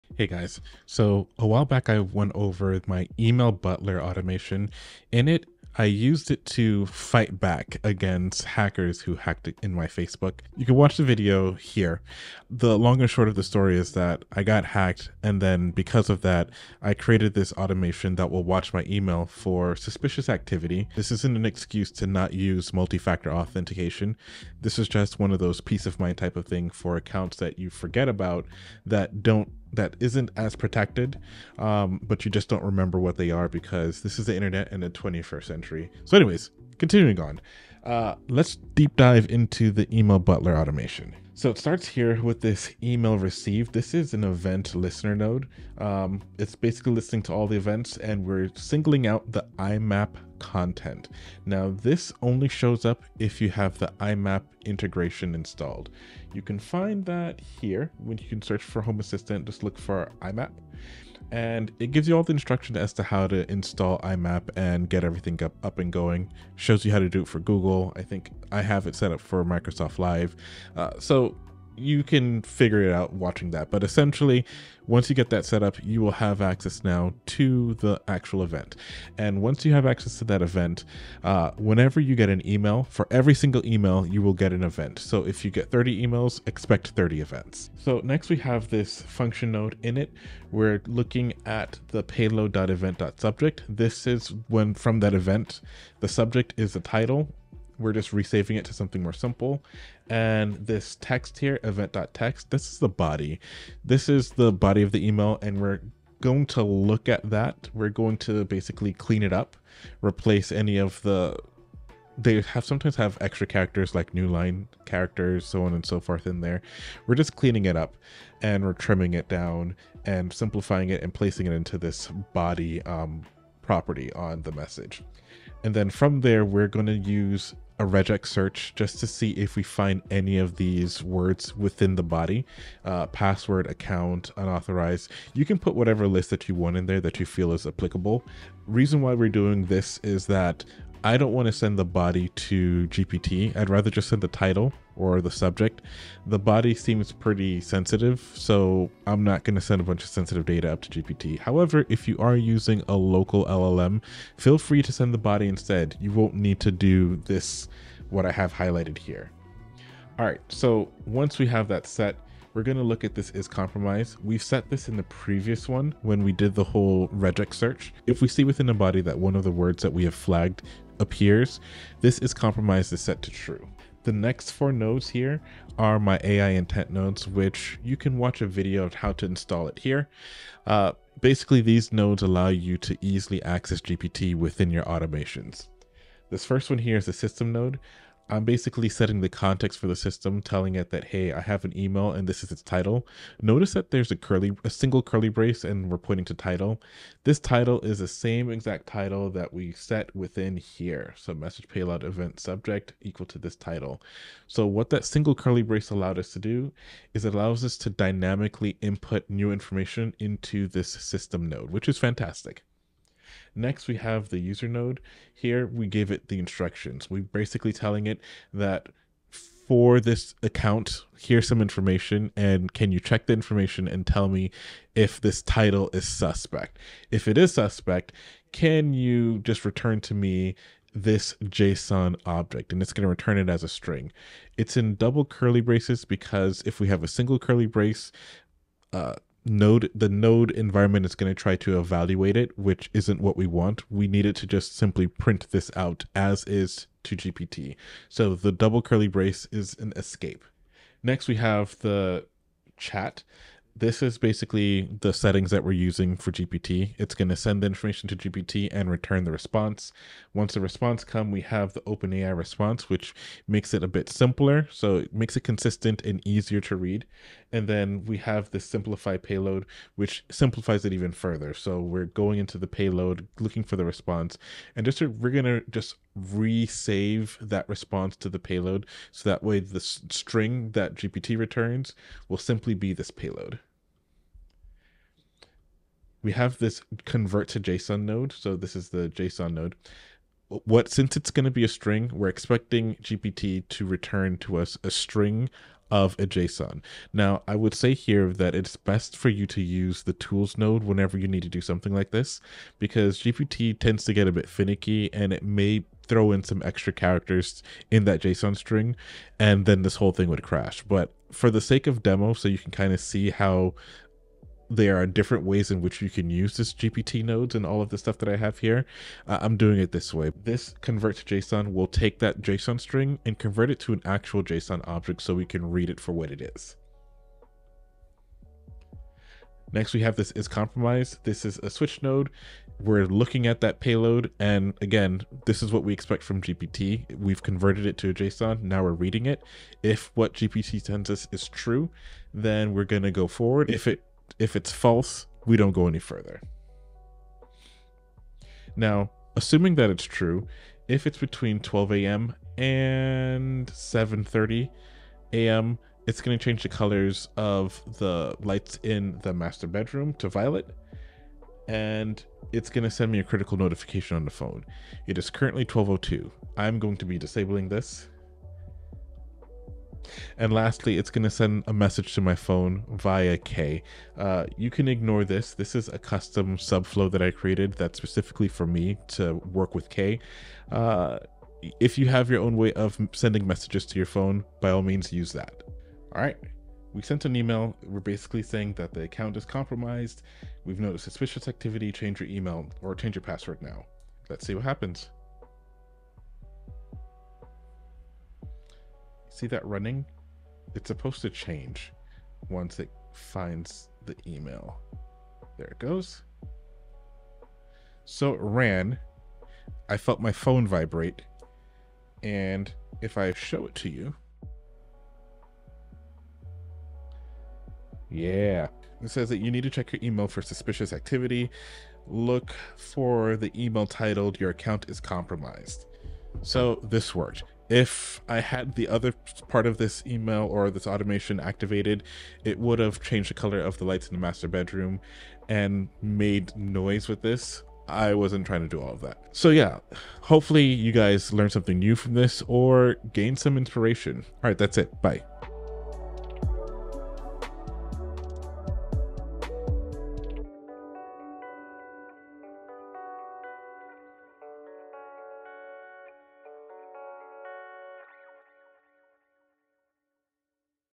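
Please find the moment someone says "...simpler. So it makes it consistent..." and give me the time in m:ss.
4:24.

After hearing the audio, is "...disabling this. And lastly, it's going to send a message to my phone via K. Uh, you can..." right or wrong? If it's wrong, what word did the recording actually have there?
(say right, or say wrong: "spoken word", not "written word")
right.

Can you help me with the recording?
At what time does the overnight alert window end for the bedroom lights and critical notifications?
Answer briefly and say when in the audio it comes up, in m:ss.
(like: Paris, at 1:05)
7:30 a.m., at 5:53.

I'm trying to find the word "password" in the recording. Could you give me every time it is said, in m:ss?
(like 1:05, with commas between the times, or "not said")
2:13, 6:33.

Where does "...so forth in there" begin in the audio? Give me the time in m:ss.
1:55.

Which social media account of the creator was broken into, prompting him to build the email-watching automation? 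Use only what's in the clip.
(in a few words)
Facebook.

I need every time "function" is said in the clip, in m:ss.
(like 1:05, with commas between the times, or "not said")
1:29.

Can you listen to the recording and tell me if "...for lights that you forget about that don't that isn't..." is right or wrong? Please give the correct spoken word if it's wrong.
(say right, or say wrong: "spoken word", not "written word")
wrong: "accounts", not "lights".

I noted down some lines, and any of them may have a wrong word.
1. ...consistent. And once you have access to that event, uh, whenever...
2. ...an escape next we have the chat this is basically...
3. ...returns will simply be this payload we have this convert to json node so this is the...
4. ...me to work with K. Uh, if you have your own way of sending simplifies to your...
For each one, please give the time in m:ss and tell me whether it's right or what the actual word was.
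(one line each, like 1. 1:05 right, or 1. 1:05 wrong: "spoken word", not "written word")
1. 1:18 wrong: "event", not "consistent"
2. 4:09 right
3. 4:41 right
4. 6:18 wrong: "messages", not "simplifies".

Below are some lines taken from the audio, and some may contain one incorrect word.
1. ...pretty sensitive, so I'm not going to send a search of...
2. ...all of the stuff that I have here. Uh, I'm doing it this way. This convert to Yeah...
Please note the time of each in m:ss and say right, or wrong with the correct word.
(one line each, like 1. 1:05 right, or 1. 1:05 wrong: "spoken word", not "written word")
1. 2:27 wrong: "bunch", not "search"
2. 5:17 wrong: "JSON", not "Yeah".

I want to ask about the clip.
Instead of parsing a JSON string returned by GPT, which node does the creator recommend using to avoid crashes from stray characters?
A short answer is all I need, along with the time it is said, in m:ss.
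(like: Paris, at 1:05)
the tools node, at 5:00.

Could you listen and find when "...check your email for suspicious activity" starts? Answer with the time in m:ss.
6:59.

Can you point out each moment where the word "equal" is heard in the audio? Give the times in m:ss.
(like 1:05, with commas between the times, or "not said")
3:23.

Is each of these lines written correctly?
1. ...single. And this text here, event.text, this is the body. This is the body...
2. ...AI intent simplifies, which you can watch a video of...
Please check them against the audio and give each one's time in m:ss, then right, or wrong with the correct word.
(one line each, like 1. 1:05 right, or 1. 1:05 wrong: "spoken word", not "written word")
1. 1:39 wrong: "simple", not "single"
2. 2:56 wrong: "nodes", not "simplifies".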